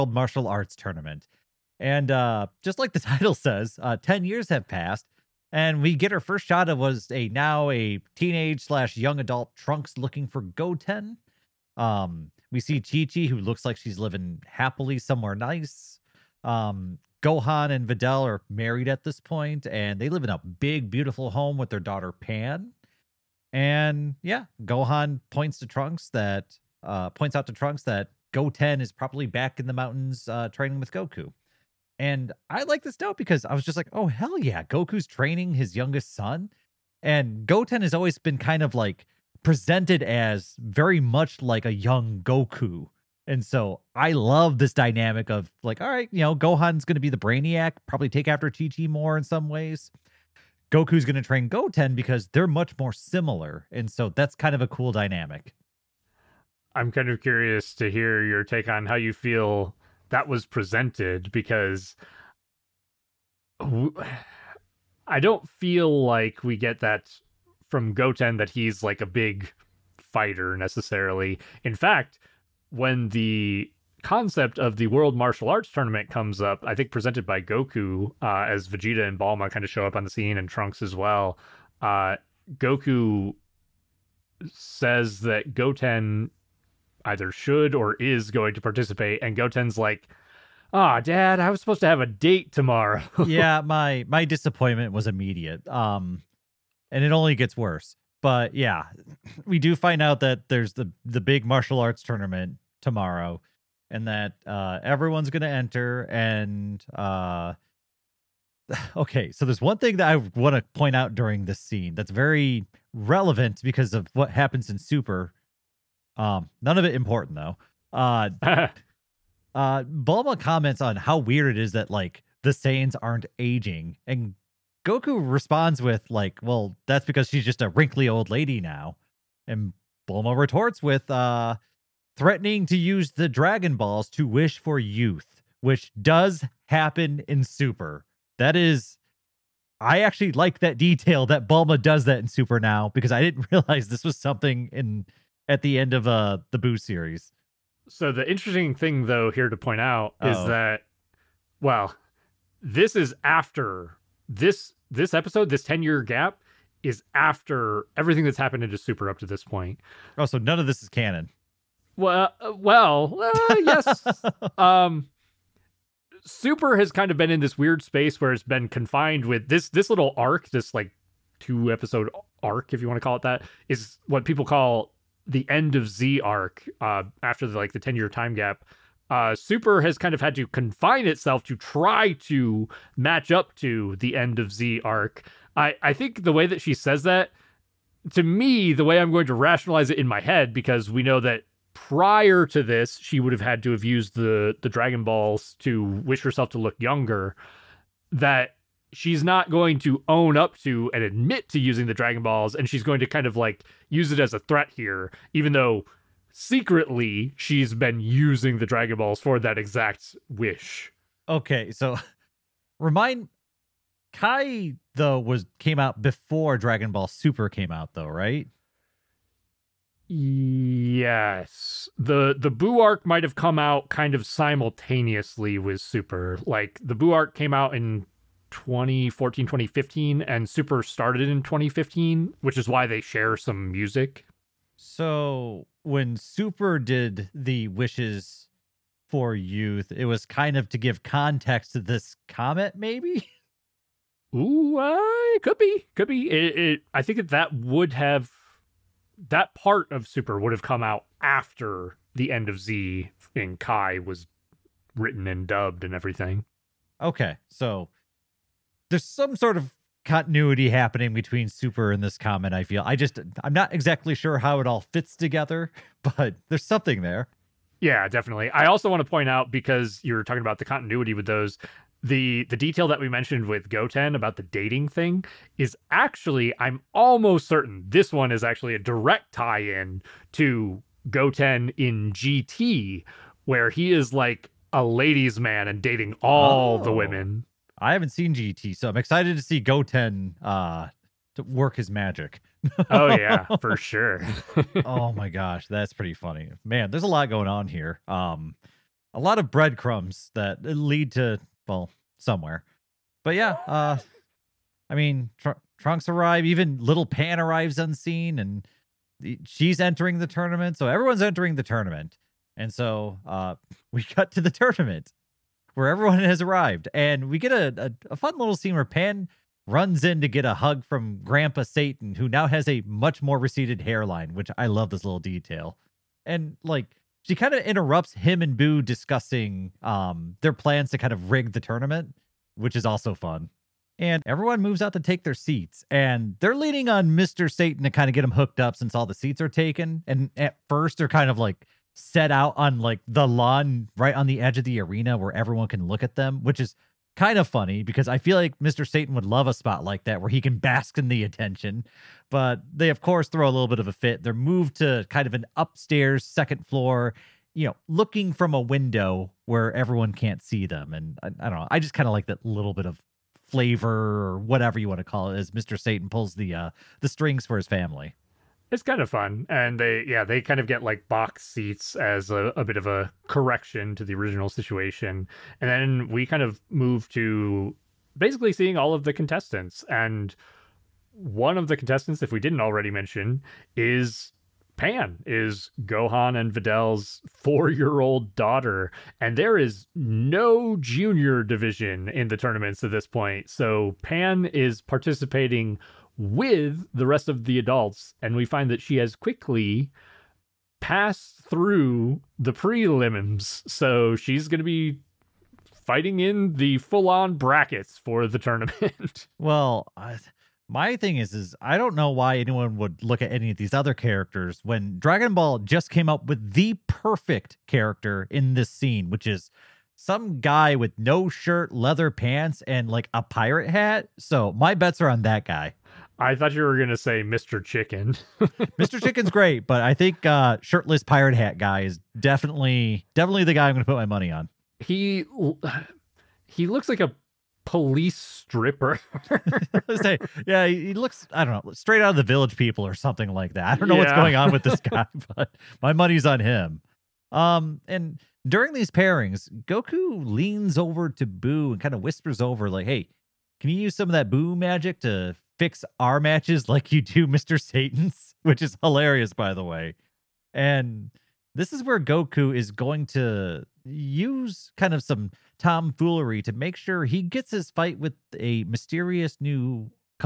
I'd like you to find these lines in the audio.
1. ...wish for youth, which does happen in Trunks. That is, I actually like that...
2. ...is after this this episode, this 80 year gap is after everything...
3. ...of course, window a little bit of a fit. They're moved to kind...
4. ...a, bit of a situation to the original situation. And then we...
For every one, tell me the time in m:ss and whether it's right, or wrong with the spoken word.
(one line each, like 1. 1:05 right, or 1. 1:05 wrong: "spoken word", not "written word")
1. 2:14 wrong: "Super", not "Trunks"
2. 2:32 wrong: "10", not "80"
3. 5:52 wrong: "throw", not "window"
4. 6:12 wrong: "correction", not "situation".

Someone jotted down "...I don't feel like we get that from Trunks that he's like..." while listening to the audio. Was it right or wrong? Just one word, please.
wrong.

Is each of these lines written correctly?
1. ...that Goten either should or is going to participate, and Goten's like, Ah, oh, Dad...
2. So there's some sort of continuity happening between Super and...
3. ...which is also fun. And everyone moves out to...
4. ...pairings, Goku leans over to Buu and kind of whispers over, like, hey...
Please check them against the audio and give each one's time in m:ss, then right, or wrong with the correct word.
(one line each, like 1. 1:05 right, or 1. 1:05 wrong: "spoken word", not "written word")
1. 1:25 right
2. 4:17 right
3. 5:32 right
4. 7:28 right.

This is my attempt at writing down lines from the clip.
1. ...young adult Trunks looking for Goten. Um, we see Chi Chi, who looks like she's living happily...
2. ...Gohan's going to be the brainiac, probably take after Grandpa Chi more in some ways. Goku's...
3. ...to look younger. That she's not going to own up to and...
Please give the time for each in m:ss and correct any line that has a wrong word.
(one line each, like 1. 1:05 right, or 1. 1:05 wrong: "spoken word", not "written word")
1. 0:08 right
2. 0:46 wrong: "Chi", not "Grandpa"
3. 3:16 right.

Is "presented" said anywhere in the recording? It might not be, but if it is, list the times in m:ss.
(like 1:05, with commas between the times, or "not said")
0:39, 1:00, 1:16.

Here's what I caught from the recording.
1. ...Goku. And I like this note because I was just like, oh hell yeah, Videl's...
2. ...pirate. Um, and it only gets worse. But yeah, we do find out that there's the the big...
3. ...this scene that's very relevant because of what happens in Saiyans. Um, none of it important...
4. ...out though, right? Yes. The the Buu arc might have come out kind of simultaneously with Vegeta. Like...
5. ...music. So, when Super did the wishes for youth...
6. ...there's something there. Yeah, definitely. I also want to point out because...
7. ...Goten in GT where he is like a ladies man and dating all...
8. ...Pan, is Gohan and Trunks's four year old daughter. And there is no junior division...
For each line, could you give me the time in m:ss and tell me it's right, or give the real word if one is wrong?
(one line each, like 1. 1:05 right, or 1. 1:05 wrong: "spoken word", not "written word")
1. 0:30 wrong: "Goku", not "Videl"
2. 1:35 wrong: "immediate", not "pirate"
3. 1:51 wrong: "Super", not "Saiyans"
4. 3:37 wrong: "Super", not "Vegeta"
5. 3:53 right
6. 4:26 right
7. 4:41 right
8. 6:24 wrong: "Videl", not "Trunks".